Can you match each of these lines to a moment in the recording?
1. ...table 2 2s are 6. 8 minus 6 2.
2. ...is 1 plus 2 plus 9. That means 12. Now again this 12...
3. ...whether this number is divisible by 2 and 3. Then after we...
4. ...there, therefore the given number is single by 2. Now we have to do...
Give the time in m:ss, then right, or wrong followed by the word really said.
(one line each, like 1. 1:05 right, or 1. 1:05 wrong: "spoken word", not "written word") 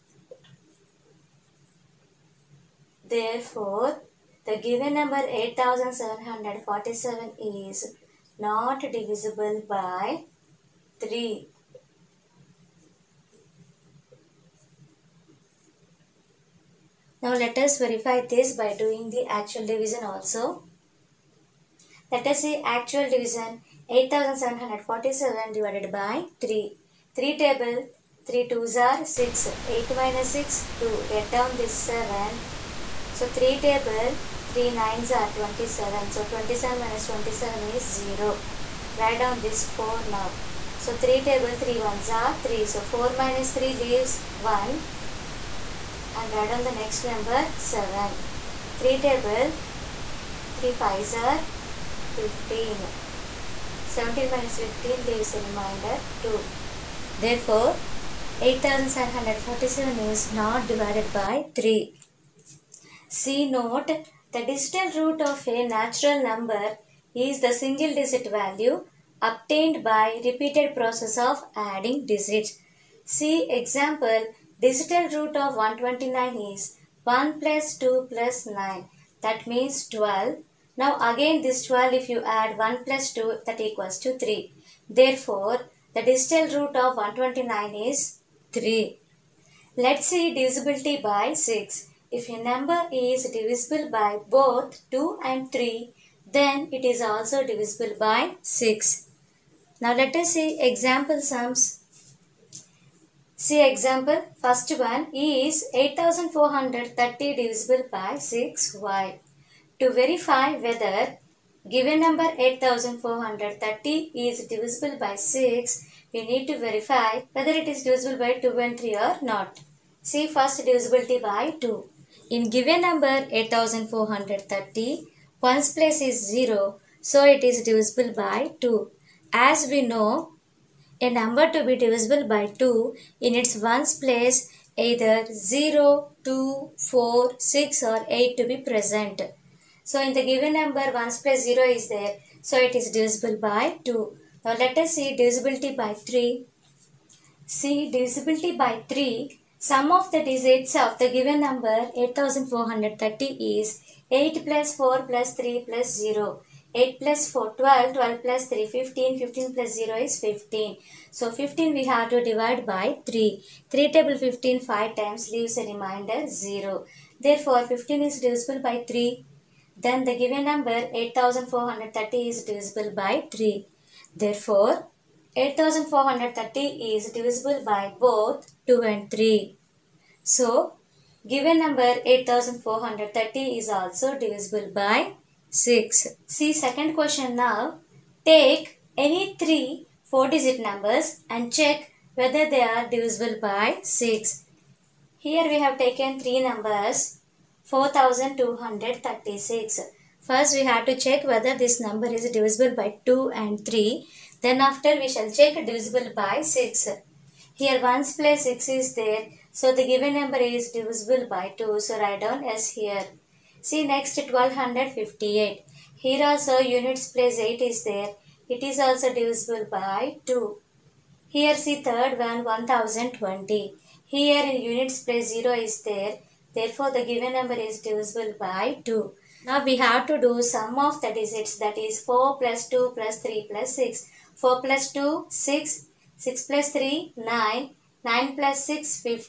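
1. 0:27 wrong: "3", not "2"
2. 1:16 right
3. 3:21 right
4. 3:45 wrong: "divisible", not "single".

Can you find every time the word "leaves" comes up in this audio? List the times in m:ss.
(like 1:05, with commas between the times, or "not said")
0:43, 0:55.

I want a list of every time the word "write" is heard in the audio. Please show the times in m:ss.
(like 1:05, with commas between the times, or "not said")
0:38, 0:46, 3:31.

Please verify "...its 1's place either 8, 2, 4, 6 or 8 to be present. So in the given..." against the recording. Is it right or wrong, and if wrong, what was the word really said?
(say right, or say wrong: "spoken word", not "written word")
wrong: "0", not "8".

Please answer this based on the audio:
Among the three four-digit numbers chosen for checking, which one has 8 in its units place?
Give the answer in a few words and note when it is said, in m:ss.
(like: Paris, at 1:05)
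1258, at 3:34.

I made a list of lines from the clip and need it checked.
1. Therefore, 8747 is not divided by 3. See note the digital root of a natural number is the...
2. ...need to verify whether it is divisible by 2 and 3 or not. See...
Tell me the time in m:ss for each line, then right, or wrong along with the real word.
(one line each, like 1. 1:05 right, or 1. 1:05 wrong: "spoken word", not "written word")
1. 0:57 right
2. 1:56 right.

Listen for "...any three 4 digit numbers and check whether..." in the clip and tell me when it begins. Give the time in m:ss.
3:09.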